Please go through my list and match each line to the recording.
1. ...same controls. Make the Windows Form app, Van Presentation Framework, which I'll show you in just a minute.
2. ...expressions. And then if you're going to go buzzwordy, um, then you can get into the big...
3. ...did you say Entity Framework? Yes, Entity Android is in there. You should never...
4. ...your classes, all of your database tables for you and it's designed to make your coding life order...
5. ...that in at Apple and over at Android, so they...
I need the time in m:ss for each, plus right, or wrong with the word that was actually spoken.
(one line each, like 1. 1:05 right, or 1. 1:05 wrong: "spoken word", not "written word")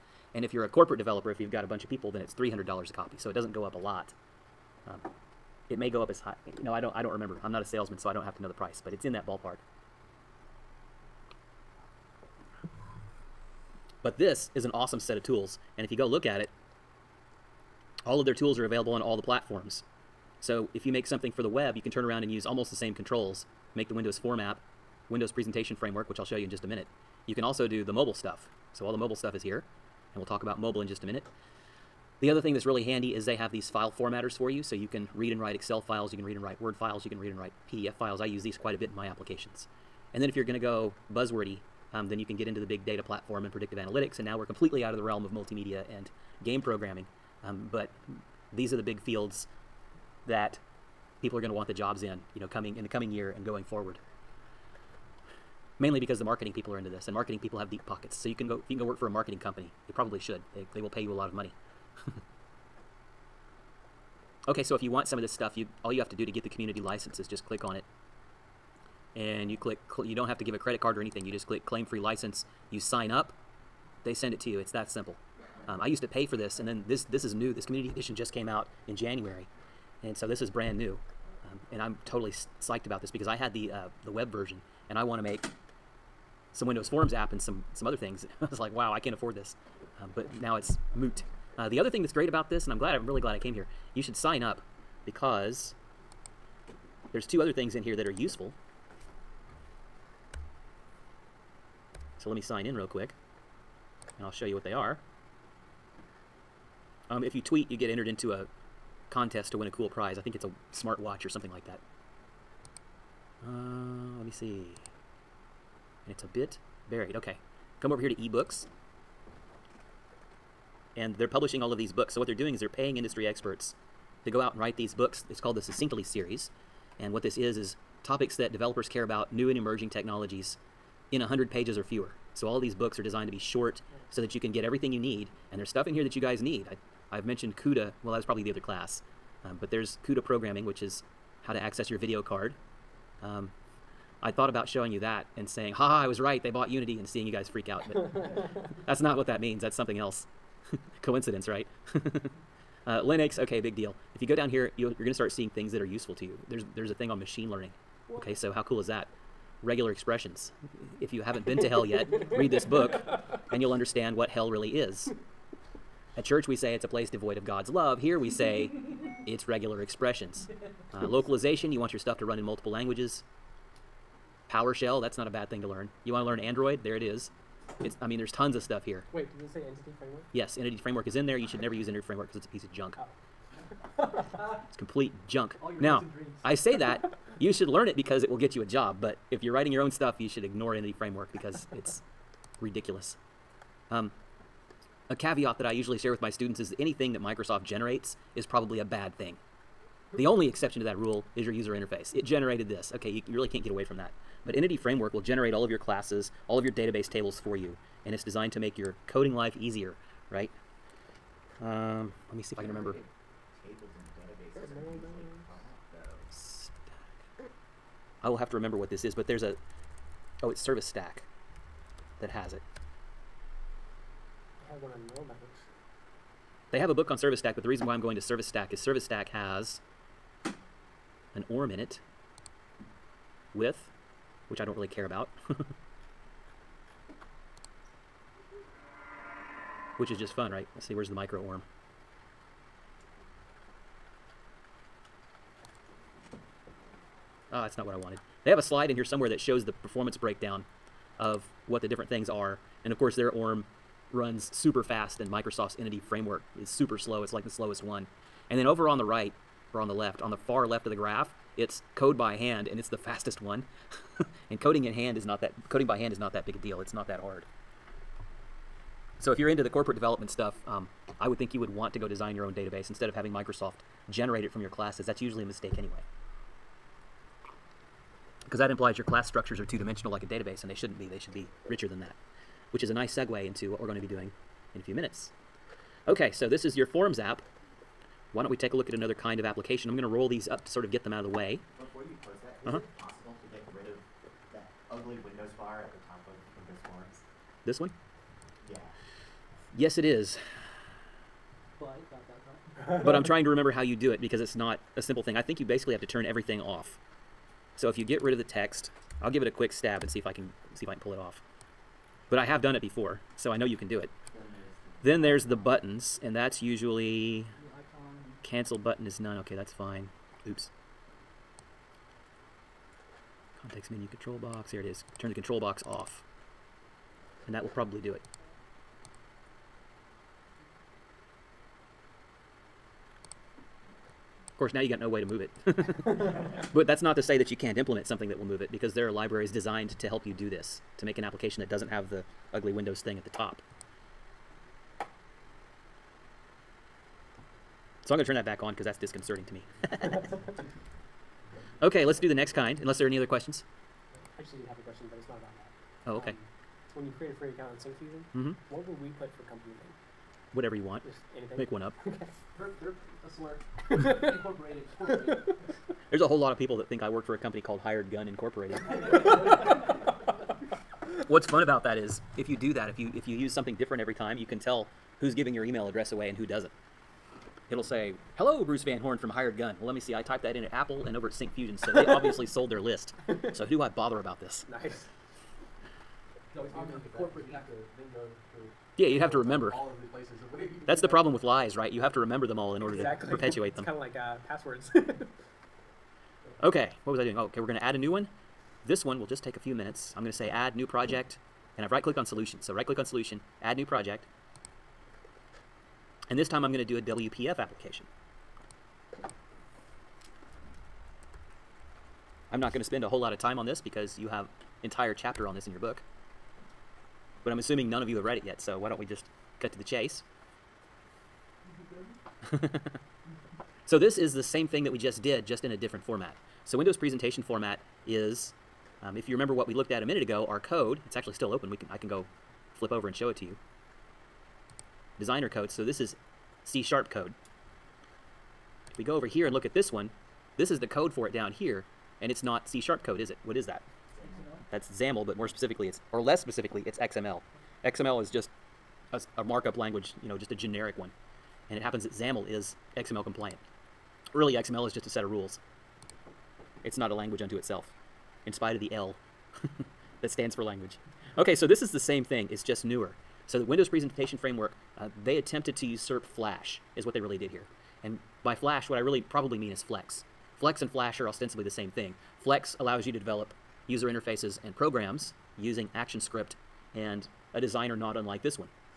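1. 0:22 wrong: "Windows", not "Van"
2. 0:39 wrong: "applications", not "expressions"
3. 2:59 wrong: "Framework", not "Android"
4. 3:25 wrong: "easier", not "order"
5. 6:20 wrong: "Syncfusion", not "Android".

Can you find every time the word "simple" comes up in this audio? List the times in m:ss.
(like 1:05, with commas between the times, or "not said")
1:14, 5:05.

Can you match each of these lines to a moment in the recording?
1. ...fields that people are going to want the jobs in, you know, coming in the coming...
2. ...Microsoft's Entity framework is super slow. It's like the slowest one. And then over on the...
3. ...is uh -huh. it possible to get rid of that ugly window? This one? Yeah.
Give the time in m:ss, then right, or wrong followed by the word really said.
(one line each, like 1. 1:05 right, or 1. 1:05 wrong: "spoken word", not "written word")
1. 0:48 right
2. 4:15 right
3. 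4:52 right.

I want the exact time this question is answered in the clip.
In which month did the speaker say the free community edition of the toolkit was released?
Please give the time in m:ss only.
1:18.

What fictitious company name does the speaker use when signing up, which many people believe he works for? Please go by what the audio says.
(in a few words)
Hired Gun Incorporated.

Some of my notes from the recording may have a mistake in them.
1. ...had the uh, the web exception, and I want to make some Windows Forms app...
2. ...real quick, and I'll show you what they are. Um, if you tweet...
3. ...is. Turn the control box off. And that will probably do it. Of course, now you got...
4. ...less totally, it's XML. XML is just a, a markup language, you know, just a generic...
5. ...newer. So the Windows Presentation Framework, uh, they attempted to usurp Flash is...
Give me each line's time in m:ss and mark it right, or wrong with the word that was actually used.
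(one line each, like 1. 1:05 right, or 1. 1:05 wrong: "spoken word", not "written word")
1. 1:23 wrong: "version", not "exception"
2. 1:42 right
3. 5:24 right
4. 7:26 wrong: "specifically", not "totally"
5. 7:42 right.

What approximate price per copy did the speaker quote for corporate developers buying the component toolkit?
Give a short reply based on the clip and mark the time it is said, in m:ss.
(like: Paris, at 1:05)
$300, at 0:02.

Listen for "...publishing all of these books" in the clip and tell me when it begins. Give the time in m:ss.
2:01.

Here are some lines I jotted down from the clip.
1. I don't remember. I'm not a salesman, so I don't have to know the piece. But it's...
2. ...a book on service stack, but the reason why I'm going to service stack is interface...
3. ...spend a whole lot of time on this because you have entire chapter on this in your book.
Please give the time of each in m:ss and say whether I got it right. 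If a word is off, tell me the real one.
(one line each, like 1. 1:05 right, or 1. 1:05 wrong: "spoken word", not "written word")
1. 0:06 wrong: "price", not "piece"
2. 3:46 wrong: "service", not "interface"
3. 6:52 right.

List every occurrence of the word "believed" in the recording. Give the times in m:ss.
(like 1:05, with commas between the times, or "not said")
not said.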